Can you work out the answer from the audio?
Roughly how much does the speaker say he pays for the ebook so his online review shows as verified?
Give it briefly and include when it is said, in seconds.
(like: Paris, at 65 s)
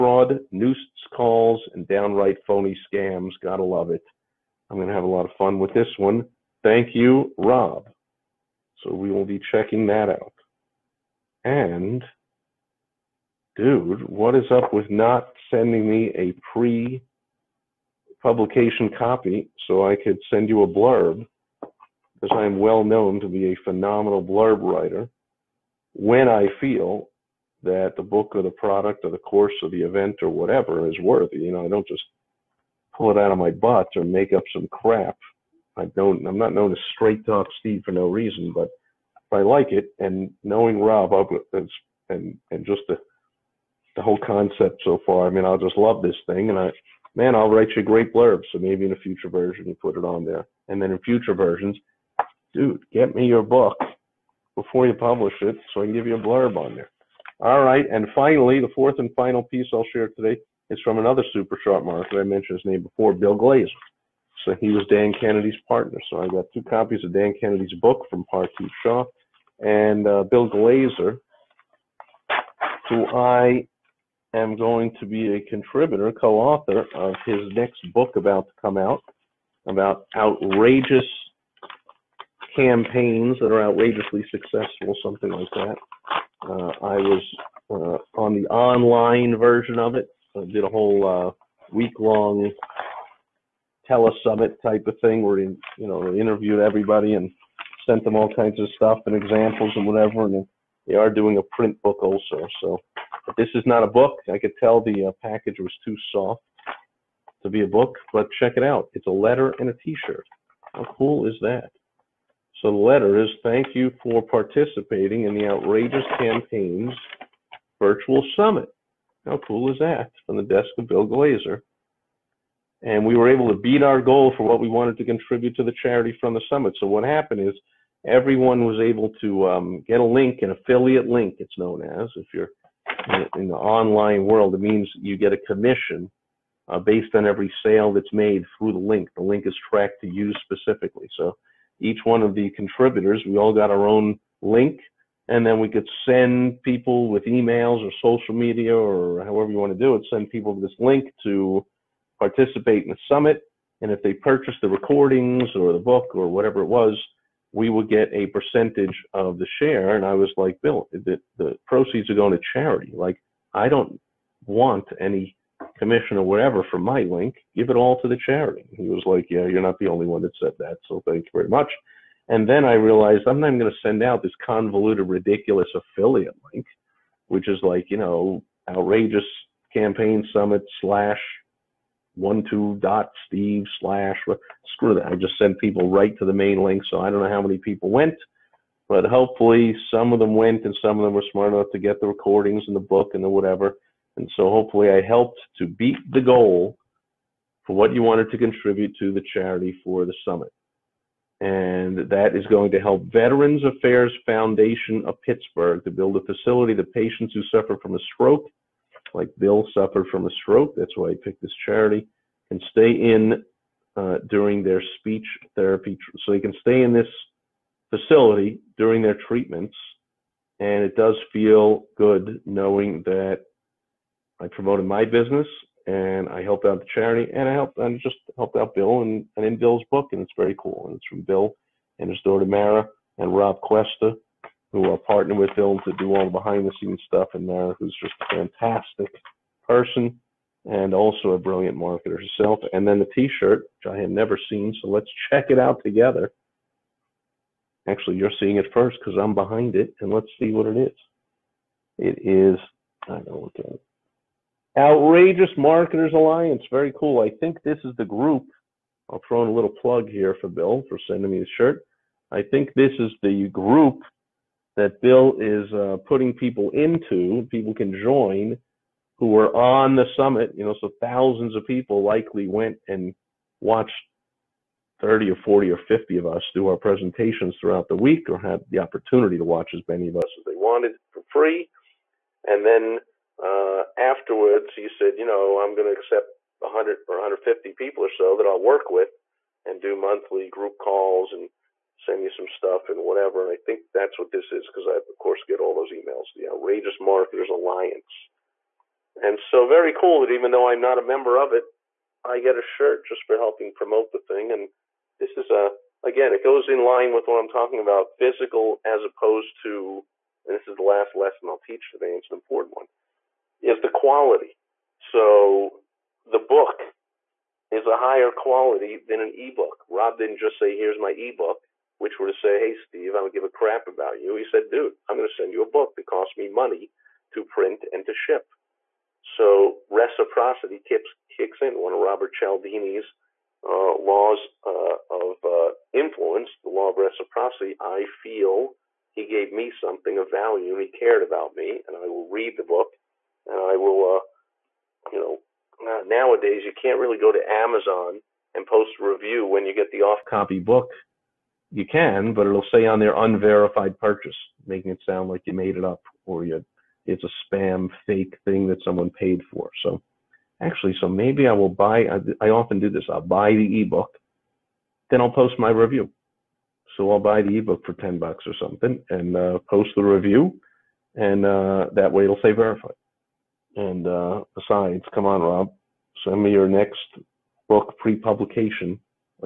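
$10, at 367 s.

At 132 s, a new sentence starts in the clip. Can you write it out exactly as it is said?
If you're in the online world, it means you get a commission uh, based on every sale that's made through the link.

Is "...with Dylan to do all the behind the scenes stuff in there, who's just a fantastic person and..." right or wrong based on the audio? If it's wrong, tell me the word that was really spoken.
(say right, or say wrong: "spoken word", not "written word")
right.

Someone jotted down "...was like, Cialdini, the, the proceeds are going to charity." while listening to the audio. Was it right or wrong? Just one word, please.
wrong.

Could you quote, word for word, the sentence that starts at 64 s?
So he was Dan Kennedy's partner.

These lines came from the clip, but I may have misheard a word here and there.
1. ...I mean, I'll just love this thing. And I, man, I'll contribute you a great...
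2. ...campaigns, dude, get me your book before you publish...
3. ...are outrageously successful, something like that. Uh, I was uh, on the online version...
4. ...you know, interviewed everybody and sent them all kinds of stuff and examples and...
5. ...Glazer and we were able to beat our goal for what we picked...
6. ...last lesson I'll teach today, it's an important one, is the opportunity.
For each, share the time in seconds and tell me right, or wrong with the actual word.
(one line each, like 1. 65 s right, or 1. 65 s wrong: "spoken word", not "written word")
1. 45 s wrong: "write", not "contribute"
2. 51 s wrong: "versions", not "campaigns"
3. 83 s right
4. 95 s right
5. 121 s wrong: "wanted", not "picked"
6. 310 s wrong: "quality", not "opportunity".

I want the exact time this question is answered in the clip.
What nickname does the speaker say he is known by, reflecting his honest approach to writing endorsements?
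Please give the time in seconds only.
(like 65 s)
36 s.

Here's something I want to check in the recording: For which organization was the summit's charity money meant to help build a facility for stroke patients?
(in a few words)
Veterans Affairs Foundation of Pittsburgh.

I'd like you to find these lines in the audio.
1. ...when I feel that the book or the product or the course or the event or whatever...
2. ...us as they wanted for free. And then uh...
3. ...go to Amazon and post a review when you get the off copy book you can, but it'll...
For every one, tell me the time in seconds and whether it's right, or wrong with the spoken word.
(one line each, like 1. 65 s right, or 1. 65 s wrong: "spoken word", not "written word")
1. 25 s right
2. 280 s right
3. 347 s right.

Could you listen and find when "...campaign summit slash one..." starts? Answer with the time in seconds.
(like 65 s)
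179 s.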